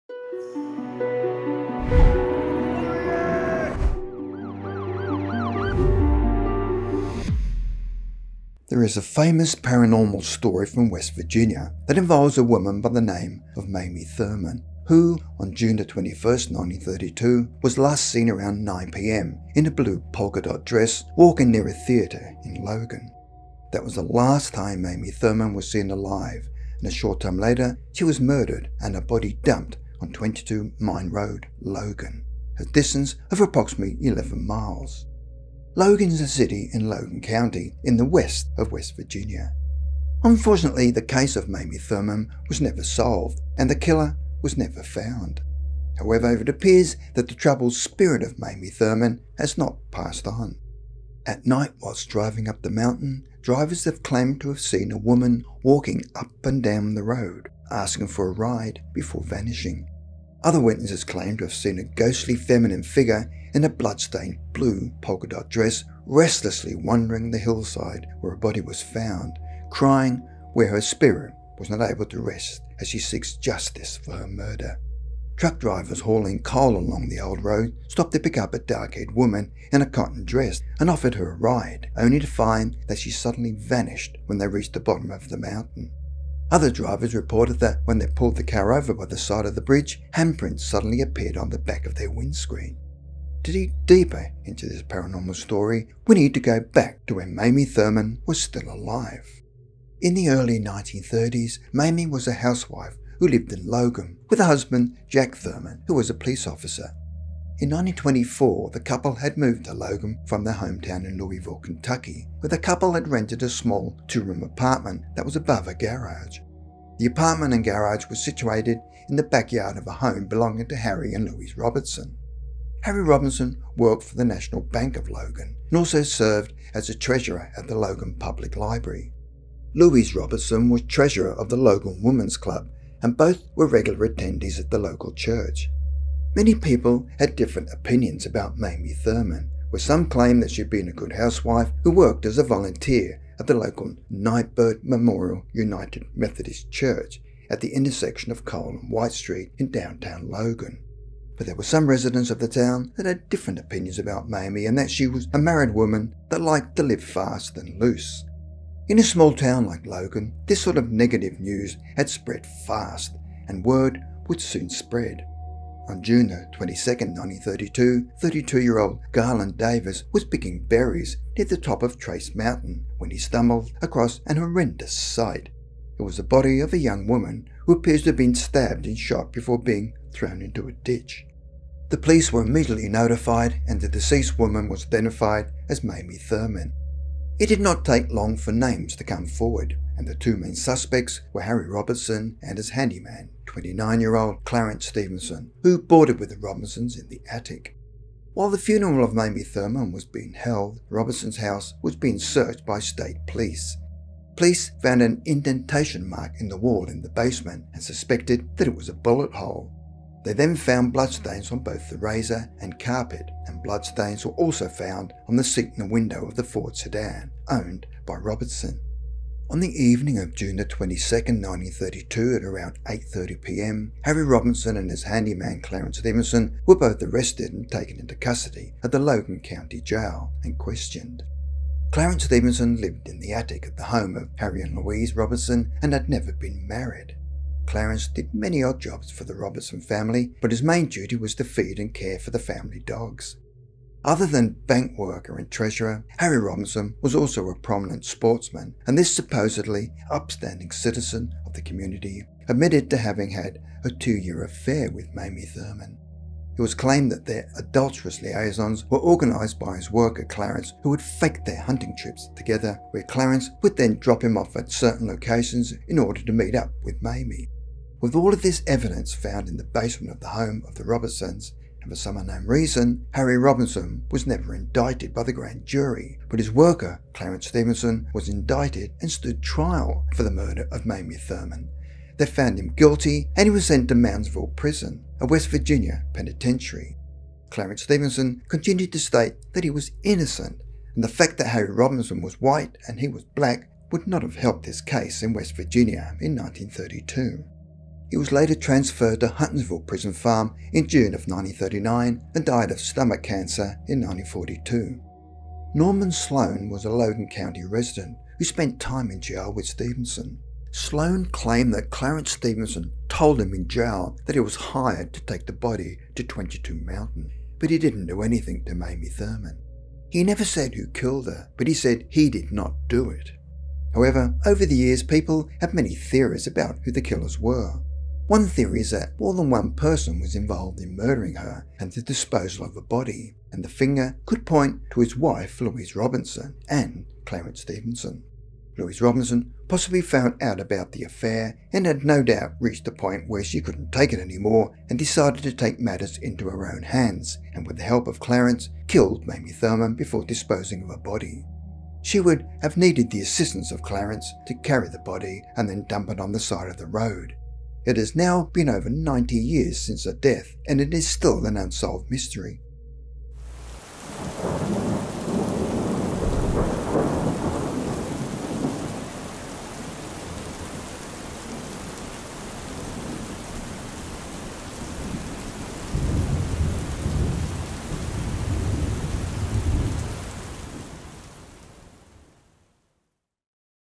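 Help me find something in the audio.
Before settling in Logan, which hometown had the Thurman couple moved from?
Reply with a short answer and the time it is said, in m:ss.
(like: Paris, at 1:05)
Louisville, Kentucky, at 1:51.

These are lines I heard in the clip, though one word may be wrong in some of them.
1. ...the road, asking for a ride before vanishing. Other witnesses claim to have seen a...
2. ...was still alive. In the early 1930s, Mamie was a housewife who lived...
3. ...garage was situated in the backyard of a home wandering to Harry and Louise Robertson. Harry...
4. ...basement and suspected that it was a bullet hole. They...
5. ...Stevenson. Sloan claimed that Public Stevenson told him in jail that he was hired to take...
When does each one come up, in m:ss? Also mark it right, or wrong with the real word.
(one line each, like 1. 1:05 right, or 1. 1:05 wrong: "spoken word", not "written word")
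1. 0:56 right
2. 1:38 right
3. 1:57 wrong: "belonging", not "wandering"
4. 3:27 right
5. 5:09 wrong: "Clarence", not "Public".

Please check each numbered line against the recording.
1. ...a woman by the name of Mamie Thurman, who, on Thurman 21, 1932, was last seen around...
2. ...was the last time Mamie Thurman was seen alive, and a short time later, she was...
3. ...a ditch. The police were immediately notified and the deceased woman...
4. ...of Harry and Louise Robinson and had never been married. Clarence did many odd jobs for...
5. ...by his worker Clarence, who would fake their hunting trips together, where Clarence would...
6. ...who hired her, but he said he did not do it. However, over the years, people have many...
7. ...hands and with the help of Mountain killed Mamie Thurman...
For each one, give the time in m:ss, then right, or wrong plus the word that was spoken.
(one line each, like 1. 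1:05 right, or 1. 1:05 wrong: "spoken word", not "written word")
1. 0:12 wrong: "June", not "Thurman"
2. 0:23 right
3. 3:00 right
4. 3:54 right
5. 4:19 right
6. 5:20 wrong: "killed", not "hired"
7. 5:46 wrong: "Clarence", not "Mountain".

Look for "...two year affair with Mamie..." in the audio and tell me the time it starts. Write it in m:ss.
4:13.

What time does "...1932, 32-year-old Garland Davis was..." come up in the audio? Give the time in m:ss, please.
2:46.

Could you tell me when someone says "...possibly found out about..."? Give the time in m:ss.
5:39.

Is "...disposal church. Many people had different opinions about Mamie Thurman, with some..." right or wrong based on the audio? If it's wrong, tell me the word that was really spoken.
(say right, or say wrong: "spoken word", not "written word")
wrong: "local", not "disposal".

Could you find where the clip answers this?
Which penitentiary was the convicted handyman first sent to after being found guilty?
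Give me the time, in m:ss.
4:43.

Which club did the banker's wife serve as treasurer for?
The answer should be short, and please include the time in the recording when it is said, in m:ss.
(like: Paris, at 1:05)
Logan Women's Club, at 2:11.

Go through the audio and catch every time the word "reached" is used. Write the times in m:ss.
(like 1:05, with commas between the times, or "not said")
1:24, 5:42.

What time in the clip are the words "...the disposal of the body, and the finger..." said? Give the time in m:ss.
5:31.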